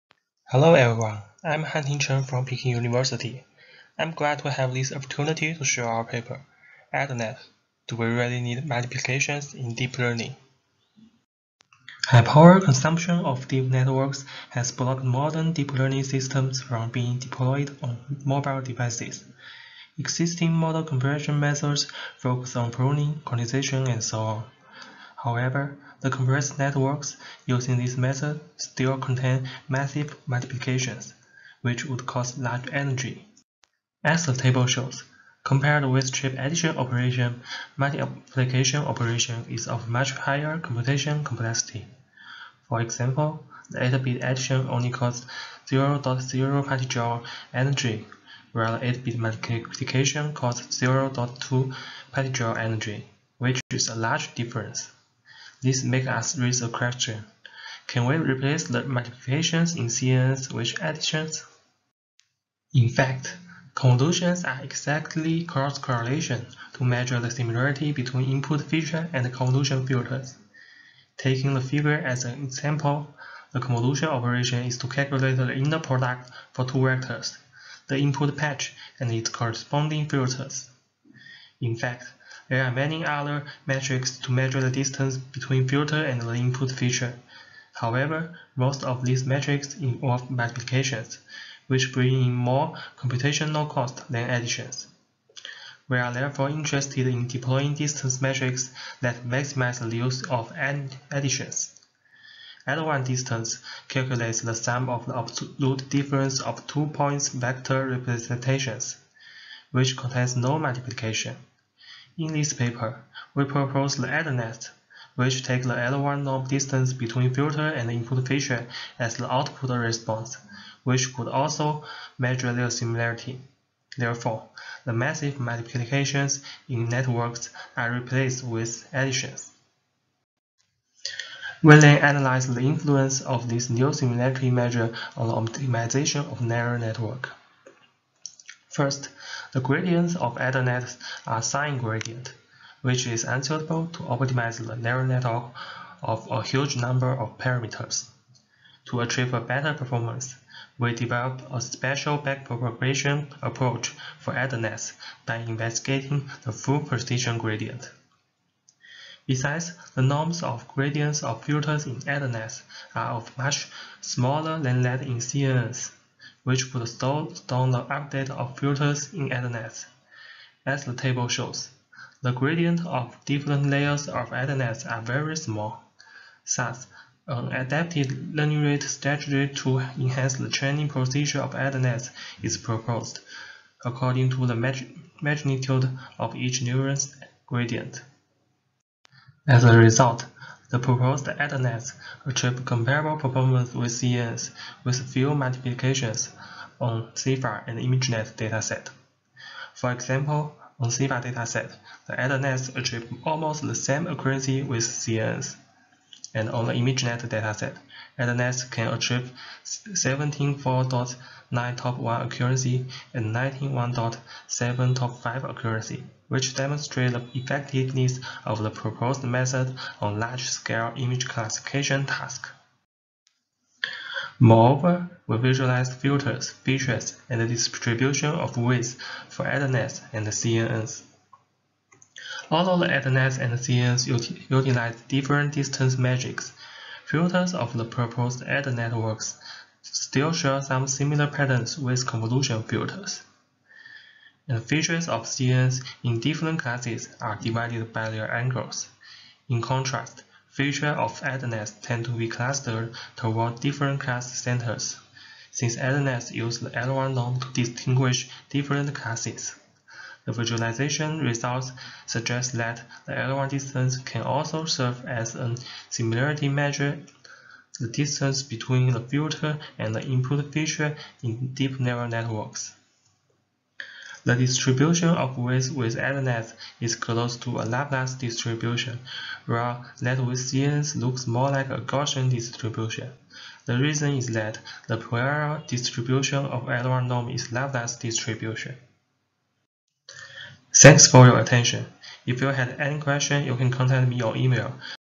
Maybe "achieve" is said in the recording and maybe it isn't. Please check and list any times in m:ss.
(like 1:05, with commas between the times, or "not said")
2:29, 3:12, 3:22, 3:28.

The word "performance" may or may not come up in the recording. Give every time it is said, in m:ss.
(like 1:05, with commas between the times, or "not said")
2:29, 3:13.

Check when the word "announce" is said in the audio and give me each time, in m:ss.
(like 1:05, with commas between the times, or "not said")
not said.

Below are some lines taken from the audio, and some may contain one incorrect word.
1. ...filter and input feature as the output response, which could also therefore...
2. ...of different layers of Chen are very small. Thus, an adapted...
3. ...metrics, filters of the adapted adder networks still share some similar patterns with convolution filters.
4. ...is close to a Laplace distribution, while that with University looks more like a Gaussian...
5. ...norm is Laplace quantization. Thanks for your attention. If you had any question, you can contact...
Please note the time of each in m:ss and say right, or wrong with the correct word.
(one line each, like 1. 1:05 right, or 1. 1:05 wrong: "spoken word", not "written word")
1. 1:57 wrong: "measure", not "therefore"
2. 2:52 wrong: "AdderNet", not "Chen"
3. 3:55 wrong: "proposed", not "adapted"
4. 4:36 wrong: "CNNs", not "University"
5. 4:47 wrong: "distribution", not "quantization".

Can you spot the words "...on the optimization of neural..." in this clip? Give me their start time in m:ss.
2:15.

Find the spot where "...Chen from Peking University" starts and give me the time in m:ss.
0:01.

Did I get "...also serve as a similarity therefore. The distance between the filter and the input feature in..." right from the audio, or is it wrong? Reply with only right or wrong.
wrong.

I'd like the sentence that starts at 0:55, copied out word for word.
This makes us raise a question.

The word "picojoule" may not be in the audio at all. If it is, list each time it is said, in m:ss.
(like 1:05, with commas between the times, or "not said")
0:46, 0:52.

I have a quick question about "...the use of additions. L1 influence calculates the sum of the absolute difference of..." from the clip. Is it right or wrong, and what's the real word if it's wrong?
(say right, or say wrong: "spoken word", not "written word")
wrong: "distance", not "influence".